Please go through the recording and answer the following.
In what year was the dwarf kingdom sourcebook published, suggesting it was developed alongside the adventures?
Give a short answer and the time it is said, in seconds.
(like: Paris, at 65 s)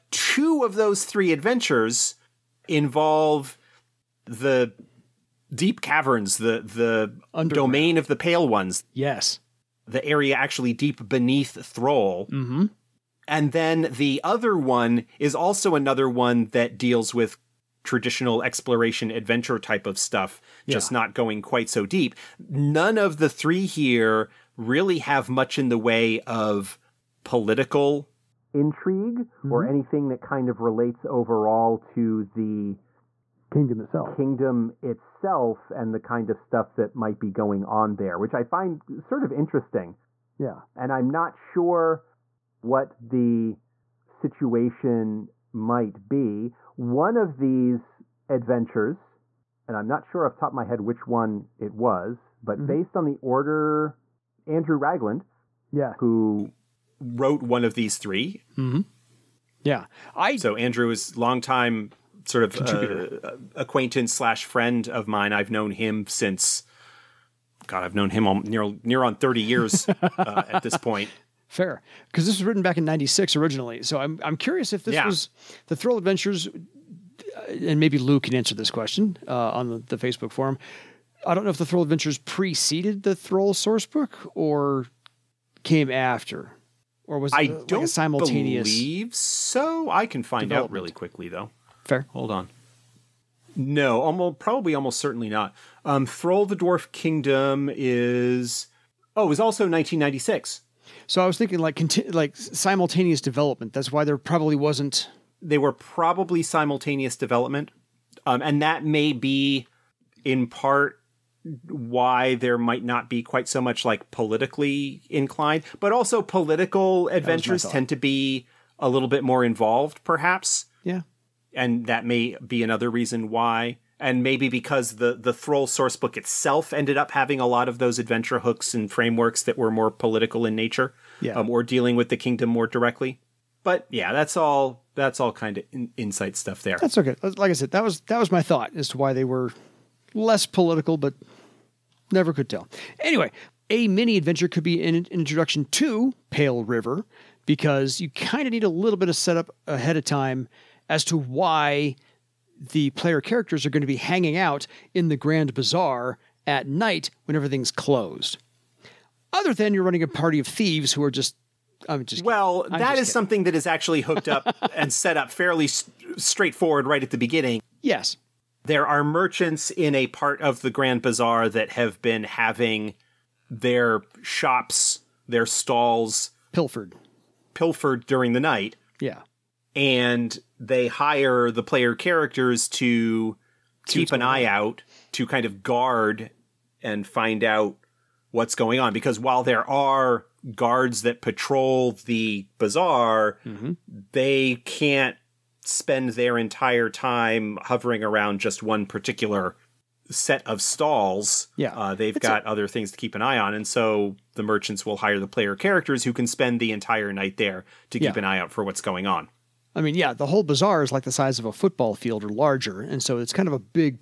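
1996, at 99 s.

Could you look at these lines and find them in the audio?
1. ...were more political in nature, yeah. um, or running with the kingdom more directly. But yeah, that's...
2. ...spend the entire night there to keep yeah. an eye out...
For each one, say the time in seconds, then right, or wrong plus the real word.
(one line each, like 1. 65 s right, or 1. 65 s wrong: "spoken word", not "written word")
1. 129 s wrong: "dealing", not "running"
2. 206 s right.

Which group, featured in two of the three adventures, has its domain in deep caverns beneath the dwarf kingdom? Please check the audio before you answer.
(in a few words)
The pale ones.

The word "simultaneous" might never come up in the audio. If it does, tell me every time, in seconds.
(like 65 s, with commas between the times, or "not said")
87 s, 102 s, 106 s.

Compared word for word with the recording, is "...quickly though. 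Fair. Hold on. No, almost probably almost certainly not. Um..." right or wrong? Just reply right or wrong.
right.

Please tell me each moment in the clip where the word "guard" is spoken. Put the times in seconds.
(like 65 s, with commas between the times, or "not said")
185 s, 190 s.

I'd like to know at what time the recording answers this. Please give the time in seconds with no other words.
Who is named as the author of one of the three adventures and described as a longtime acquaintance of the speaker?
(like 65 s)
54 s.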